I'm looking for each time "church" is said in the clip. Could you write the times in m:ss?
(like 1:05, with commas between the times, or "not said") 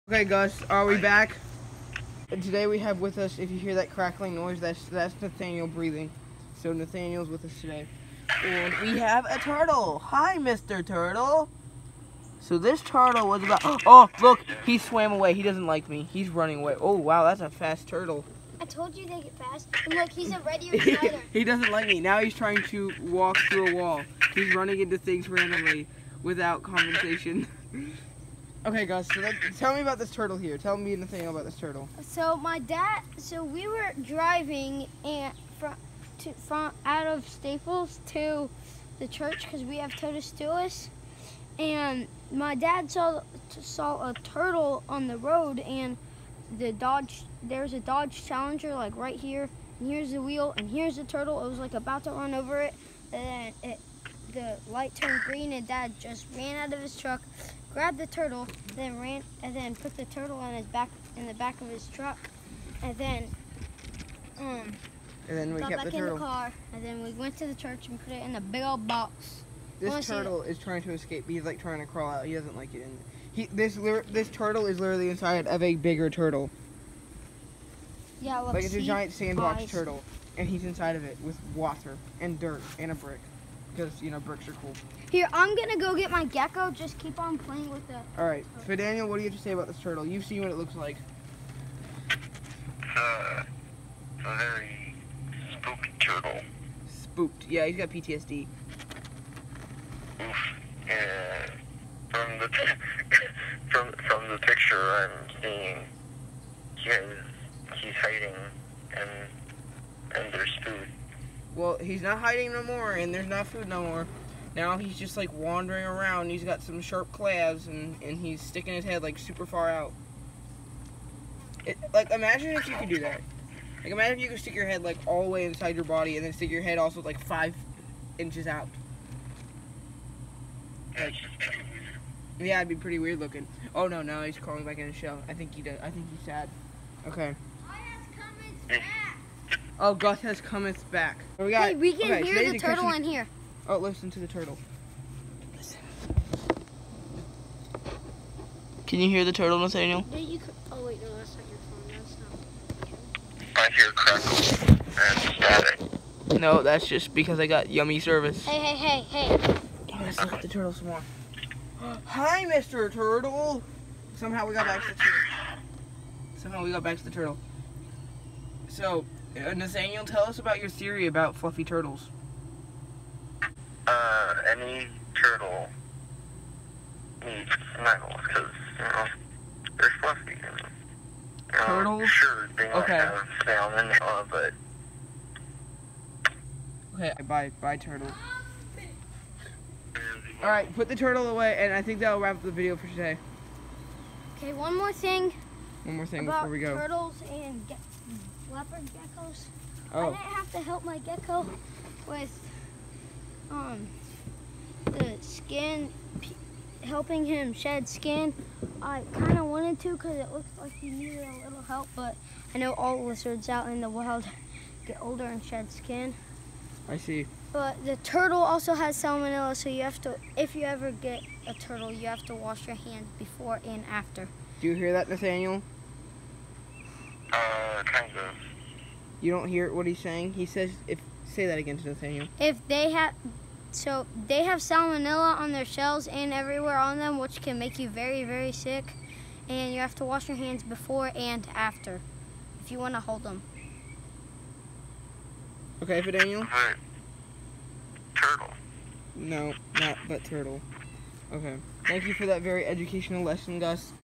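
0:39, 1:07.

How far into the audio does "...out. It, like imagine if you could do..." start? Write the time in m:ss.
1:59.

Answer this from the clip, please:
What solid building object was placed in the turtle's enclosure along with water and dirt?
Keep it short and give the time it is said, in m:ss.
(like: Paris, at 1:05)
a brick, at 1:22.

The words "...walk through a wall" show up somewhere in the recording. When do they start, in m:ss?
0:22.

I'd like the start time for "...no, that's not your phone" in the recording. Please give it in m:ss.
2:31.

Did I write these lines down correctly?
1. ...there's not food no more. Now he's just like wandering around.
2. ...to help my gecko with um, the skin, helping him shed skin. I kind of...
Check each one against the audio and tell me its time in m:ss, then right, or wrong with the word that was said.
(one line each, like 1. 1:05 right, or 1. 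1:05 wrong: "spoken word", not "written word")
1. 1:53 right
2. 3:20 right.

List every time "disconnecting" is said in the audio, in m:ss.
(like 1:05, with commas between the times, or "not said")
not said.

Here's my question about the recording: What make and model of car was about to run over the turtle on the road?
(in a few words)
Dodge Challenger.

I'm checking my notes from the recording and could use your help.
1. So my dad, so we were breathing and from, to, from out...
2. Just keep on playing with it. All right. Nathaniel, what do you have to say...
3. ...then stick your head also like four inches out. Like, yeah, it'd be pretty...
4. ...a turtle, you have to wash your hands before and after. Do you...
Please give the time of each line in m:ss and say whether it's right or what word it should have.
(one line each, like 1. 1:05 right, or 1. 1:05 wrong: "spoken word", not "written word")
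1. 0:32 wrong: "driving", not "breathing"
2. 1:26 right
3. 2:06 wrong: "five", not "four"
4. 3:41 right.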